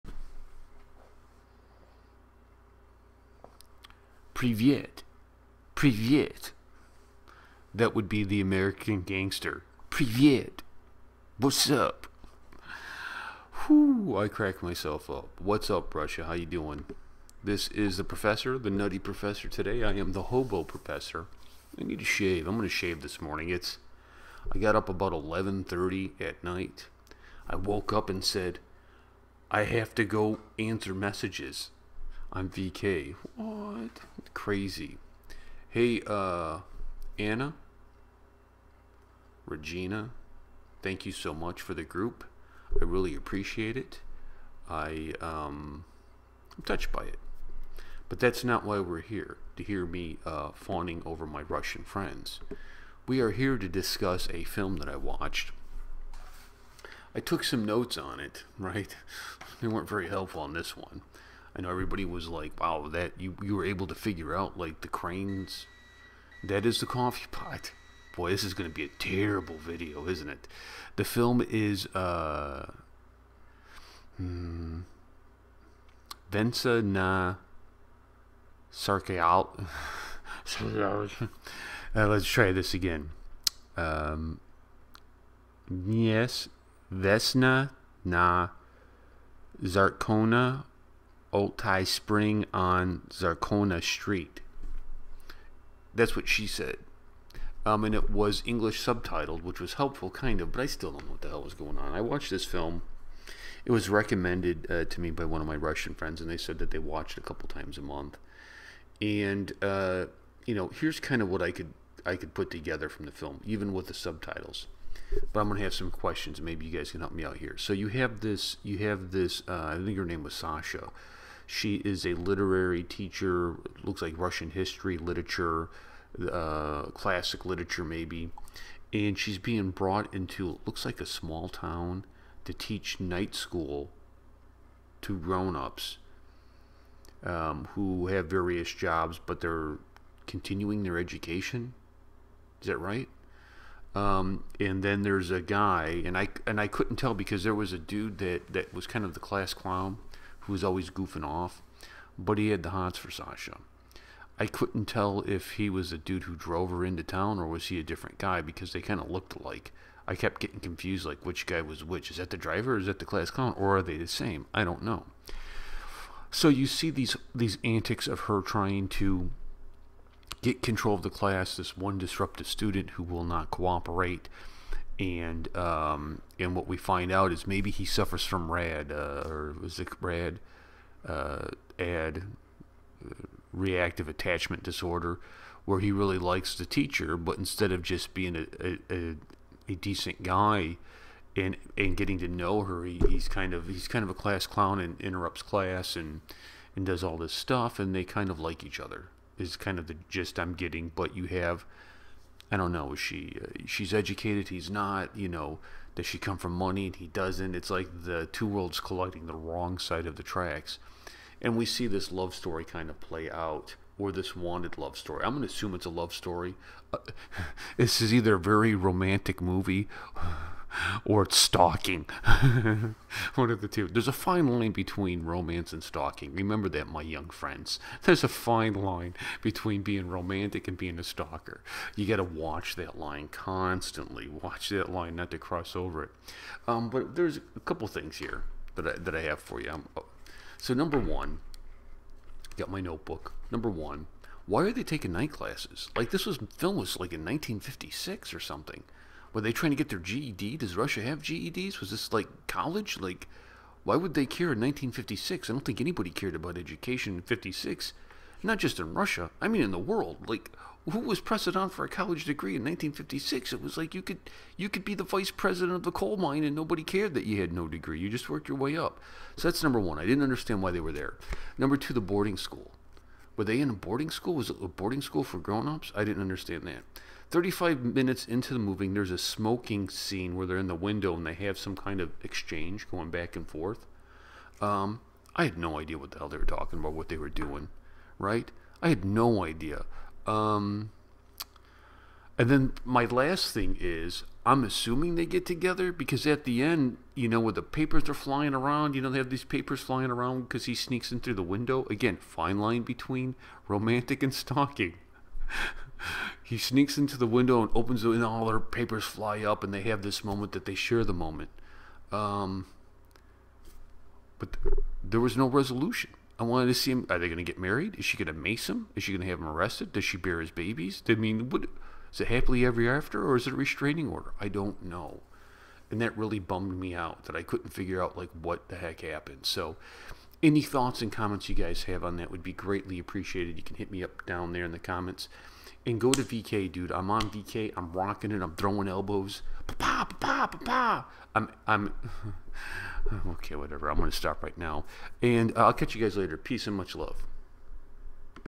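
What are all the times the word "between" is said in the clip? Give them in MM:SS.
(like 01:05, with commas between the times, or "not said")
03:44, 03:49, 05:02.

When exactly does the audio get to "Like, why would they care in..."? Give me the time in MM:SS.
04:12.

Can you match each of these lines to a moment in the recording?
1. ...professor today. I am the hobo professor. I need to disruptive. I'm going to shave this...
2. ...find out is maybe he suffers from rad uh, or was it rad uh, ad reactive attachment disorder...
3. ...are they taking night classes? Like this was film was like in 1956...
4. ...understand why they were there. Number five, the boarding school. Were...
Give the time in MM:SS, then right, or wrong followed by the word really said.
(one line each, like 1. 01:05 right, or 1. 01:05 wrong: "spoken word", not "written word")
1. 00:18 wrong: "shave", not "disruptive"
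2. 02:56 right
3. 04:04 right
4. 04:30 wrong: "two", not "five".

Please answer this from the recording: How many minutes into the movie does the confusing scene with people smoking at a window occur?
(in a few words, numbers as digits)
35.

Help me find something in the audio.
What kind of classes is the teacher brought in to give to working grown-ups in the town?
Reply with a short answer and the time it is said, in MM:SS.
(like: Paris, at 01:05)
Night school, at 02:13.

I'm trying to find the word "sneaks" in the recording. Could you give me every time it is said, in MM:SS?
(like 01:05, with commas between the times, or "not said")
05:00, 05:06.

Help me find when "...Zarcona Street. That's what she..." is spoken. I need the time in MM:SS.
01:33.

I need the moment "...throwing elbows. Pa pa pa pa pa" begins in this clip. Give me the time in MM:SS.
05:38.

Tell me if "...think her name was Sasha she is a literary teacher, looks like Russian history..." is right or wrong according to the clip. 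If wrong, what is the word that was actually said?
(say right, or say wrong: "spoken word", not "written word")
right.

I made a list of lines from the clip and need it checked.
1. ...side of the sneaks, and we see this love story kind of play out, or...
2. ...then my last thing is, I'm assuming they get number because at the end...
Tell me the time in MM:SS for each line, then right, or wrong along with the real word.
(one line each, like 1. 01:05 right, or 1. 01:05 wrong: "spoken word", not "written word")
1. 03:29 wrong: "tracks", not "sneaks"
2. 04:52 wrong: "together", not "number".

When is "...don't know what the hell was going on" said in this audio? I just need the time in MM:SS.
01:40.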